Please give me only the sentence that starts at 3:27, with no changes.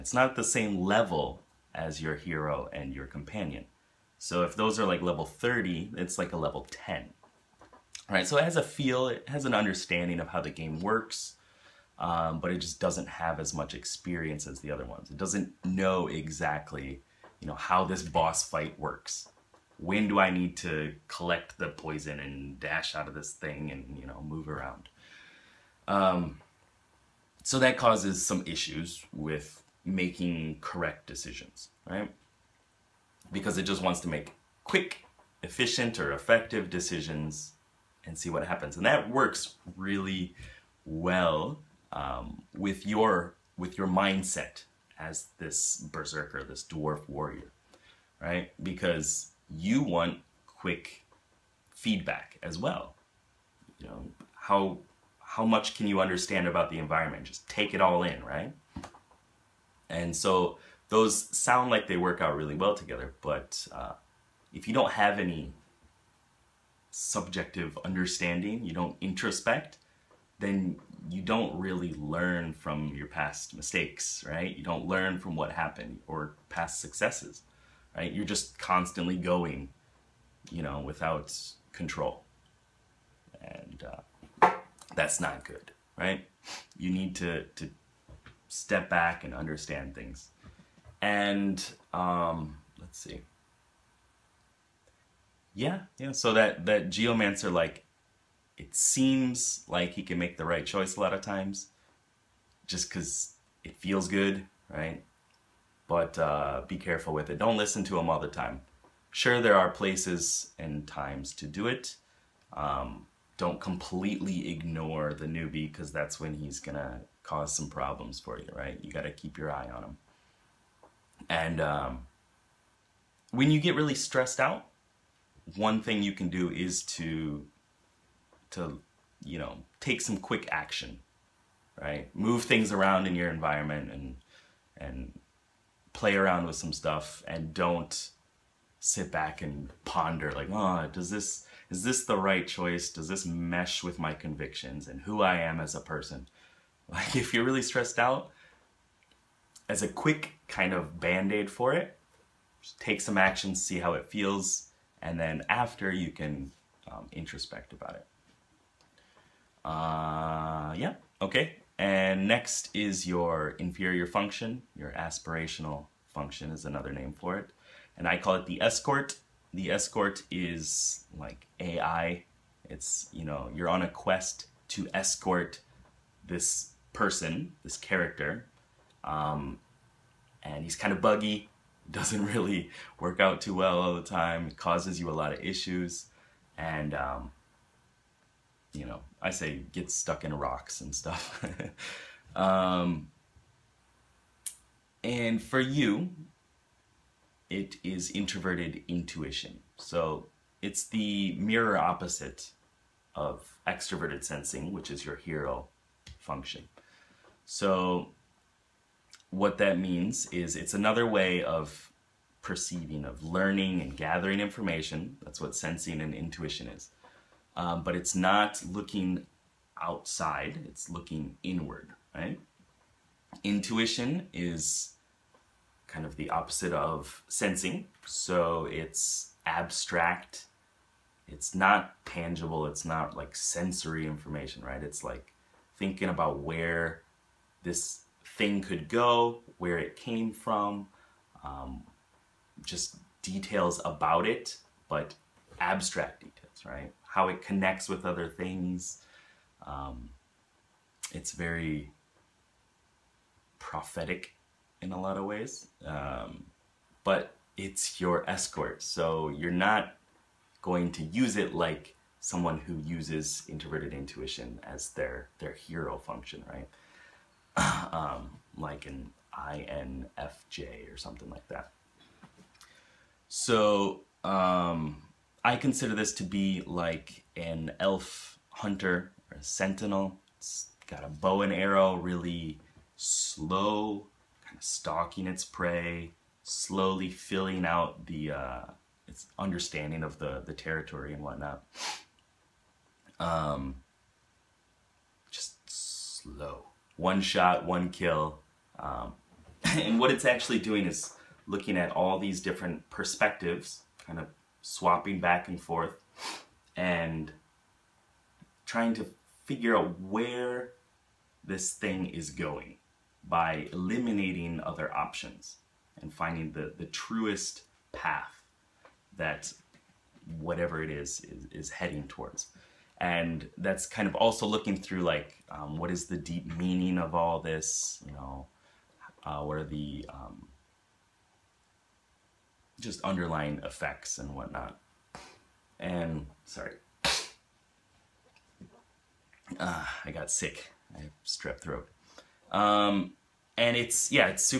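So what that means is it's another way of perceiving, of learning and gathering information.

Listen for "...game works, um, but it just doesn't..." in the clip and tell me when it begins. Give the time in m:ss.
0:10.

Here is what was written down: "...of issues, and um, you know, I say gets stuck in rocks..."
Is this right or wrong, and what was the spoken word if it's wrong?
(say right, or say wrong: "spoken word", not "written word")
right.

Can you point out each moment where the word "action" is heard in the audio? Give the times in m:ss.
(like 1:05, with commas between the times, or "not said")
2:10, 2:33.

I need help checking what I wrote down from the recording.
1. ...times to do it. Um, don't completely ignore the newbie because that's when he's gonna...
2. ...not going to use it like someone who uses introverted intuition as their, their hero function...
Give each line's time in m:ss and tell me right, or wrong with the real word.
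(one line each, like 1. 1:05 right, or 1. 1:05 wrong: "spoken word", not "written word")
1. 1:50 right
2. 4:19 right.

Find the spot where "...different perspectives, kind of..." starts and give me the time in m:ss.
5:02.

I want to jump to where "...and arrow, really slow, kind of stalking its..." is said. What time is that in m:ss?
4:41.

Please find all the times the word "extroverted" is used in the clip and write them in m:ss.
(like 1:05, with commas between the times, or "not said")
3:23.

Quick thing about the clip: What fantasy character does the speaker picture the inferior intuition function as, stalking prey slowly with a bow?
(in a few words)
Elf hunter.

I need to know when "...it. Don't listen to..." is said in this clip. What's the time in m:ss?
1:47.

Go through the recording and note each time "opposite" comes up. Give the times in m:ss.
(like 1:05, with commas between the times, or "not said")
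3:21, 3:46.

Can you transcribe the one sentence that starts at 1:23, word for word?
And uh, that's not good, right?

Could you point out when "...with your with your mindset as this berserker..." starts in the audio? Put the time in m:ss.
0:42.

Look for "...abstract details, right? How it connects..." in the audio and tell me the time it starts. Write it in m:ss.
4:05.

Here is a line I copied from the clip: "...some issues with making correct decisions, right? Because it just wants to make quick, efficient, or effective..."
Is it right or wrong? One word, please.
right.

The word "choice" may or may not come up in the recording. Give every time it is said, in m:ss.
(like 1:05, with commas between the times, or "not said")
1:40, 2:22.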